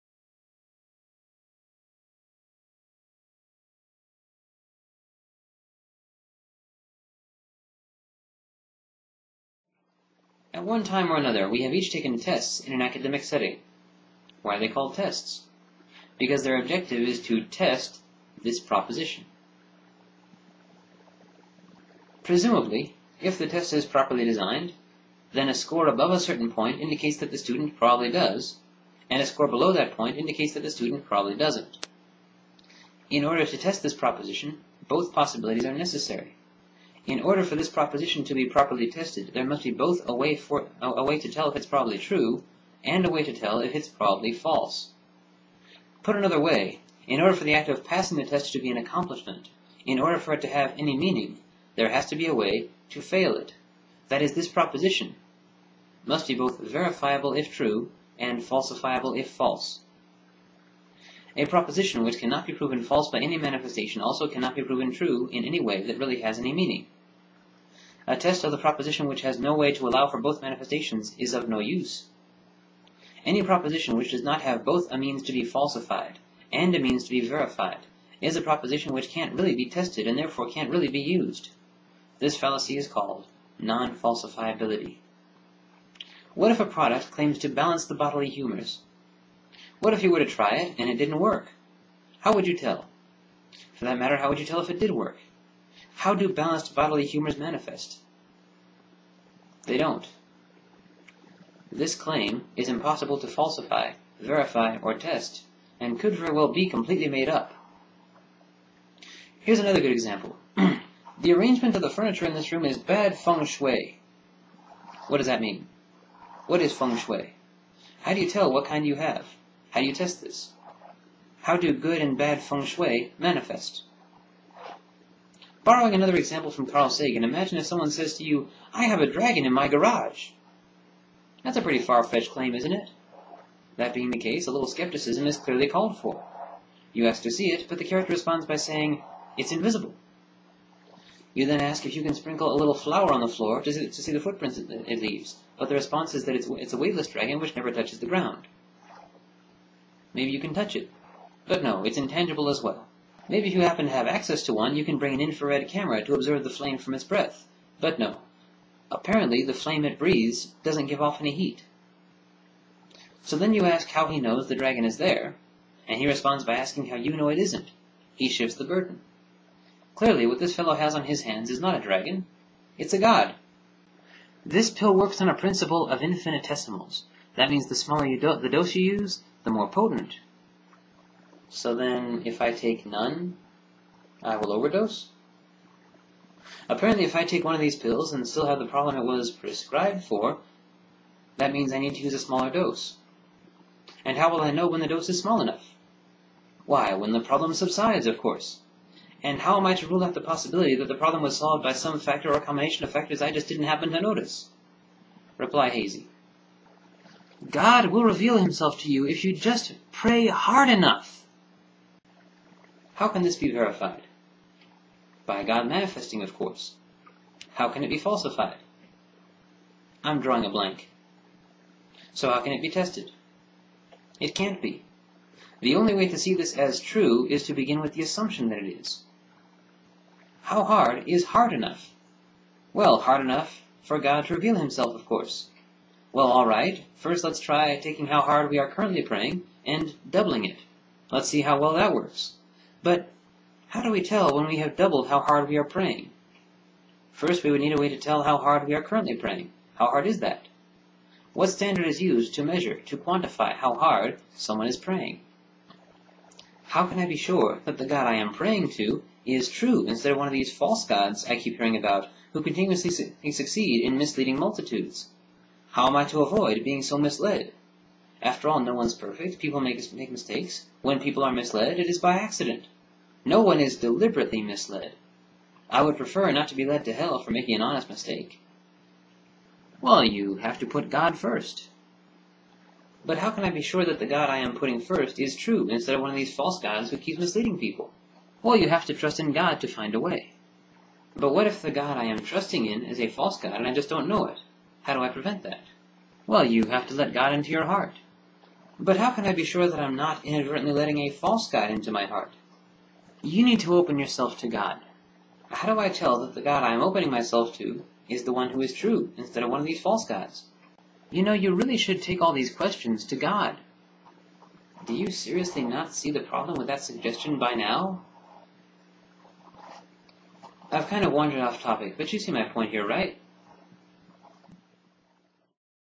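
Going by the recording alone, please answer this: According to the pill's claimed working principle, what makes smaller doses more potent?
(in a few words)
infinitesimals.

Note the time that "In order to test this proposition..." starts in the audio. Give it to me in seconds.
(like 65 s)
33 s.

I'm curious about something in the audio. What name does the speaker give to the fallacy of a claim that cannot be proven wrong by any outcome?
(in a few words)
non-falsifiability.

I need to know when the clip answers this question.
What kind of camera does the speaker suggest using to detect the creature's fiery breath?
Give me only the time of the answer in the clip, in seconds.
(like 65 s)
155 s.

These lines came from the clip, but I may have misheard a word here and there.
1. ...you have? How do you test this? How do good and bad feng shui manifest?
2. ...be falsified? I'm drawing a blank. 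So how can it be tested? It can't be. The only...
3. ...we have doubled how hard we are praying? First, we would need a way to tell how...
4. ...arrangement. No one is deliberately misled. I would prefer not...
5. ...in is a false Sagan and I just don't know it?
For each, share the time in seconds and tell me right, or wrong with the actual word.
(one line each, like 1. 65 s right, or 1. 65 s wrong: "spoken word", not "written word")
1. 118 s right
2. 217 s right
3. 244 s right
4. 272 s wrong: "accident", not "arrangement"
5. 292 s wrong: "God", not "Sagan".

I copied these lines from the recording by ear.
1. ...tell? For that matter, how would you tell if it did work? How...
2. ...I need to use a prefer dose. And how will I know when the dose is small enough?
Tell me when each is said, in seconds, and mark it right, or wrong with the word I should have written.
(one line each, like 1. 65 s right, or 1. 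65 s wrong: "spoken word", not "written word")
1. 92 s right
2. 191 s wrong: "smaller", not "prefer".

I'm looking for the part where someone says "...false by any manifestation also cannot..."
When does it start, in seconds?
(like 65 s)
62 s.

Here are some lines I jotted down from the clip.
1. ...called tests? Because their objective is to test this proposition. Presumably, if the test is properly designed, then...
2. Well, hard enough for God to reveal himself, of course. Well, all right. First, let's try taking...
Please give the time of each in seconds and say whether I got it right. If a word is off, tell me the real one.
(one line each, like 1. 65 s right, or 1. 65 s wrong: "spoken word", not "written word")
1. 14 s right
2. 232 s right.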